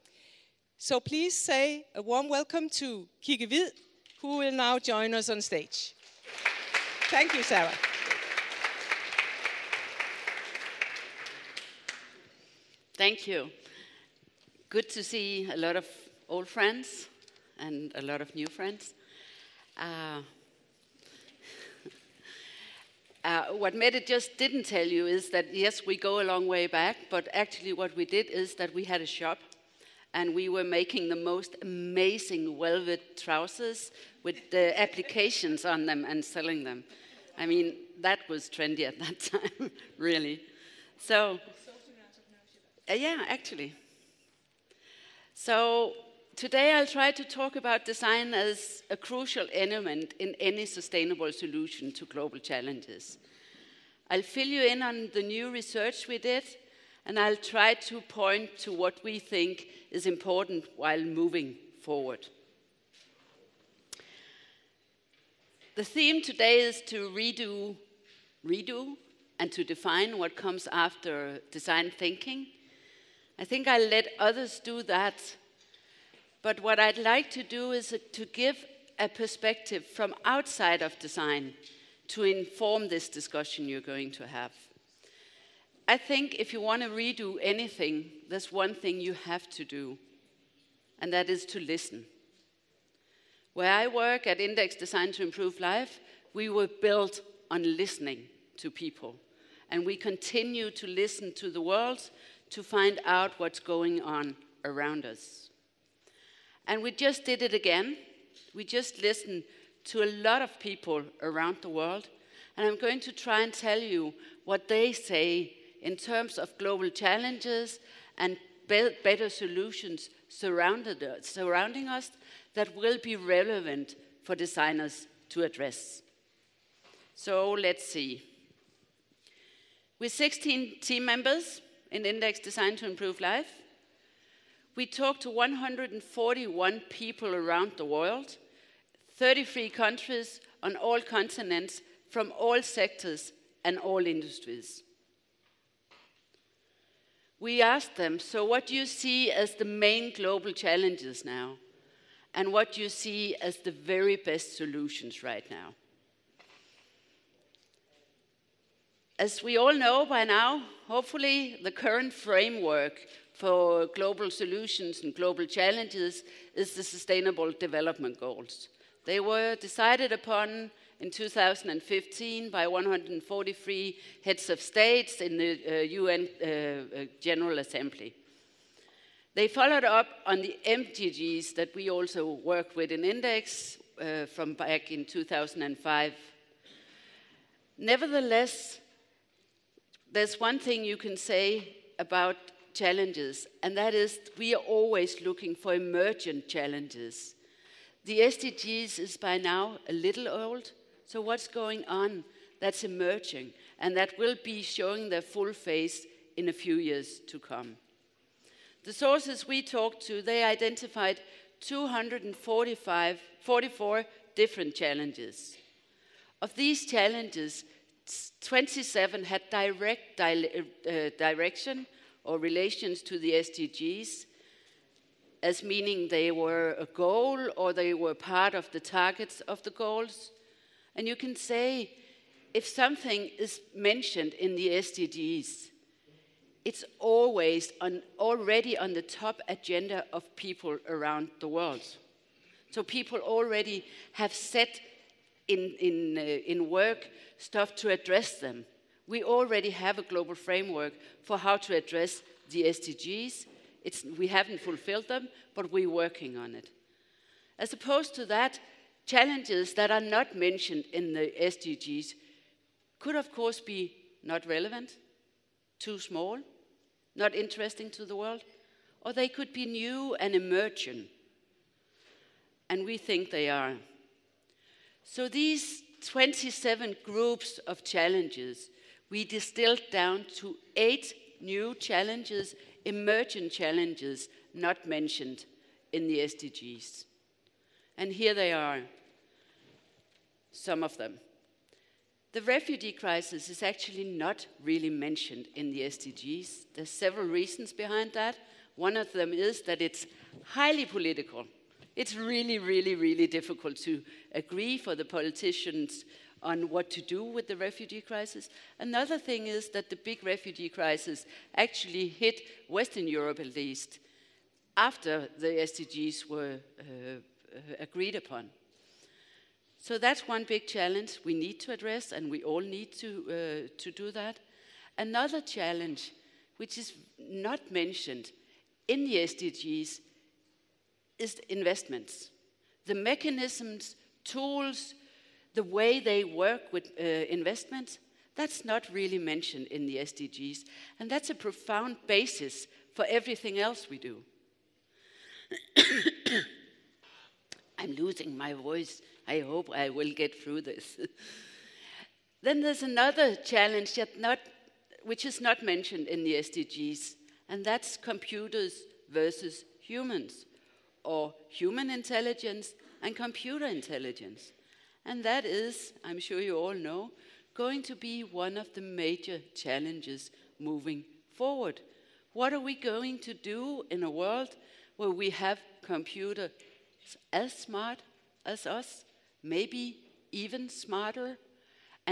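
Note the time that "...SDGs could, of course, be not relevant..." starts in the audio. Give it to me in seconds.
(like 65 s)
261 s.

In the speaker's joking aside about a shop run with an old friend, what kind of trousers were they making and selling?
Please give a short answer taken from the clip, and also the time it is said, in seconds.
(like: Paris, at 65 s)
velvet trousers, at 32 s.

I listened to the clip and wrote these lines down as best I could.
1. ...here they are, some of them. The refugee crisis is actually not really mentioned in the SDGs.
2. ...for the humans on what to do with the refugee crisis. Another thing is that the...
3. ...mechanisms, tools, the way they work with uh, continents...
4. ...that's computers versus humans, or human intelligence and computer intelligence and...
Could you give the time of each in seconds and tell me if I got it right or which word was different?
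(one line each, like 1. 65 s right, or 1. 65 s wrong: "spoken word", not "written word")
1. 288 s right
2. 304 s wrong: "politicians", not "humans"
3. 332 s wrong: "investments", not "continents"
4. 357 s right.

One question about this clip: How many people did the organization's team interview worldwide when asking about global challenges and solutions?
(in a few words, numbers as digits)
141.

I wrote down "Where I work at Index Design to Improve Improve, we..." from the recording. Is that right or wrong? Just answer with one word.
wrong.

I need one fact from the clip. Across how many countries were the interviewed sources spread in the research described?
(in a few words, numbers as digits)
33.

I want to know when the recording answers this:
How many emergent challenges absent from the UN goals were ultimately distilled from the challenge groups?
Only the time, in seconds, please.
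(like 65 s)
280 s.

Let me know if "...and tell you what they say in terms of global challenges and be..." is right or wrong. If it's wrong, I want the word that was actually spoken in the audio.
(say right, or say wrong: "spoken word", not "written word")
right.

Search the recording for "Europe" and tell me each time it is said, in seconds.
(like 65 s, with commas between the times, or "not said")
313 s.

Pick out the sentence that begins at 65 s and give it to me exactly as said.
The theme today is to redo, redo, and to define what comes after design thinking.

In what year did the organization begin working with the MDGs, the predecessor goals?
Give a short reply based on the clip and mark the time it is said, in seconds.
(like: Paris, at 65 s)
2005, at 185 s.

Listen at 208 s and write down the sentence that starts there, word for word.
The sources we talked to, they identified 245, 44 different challenges.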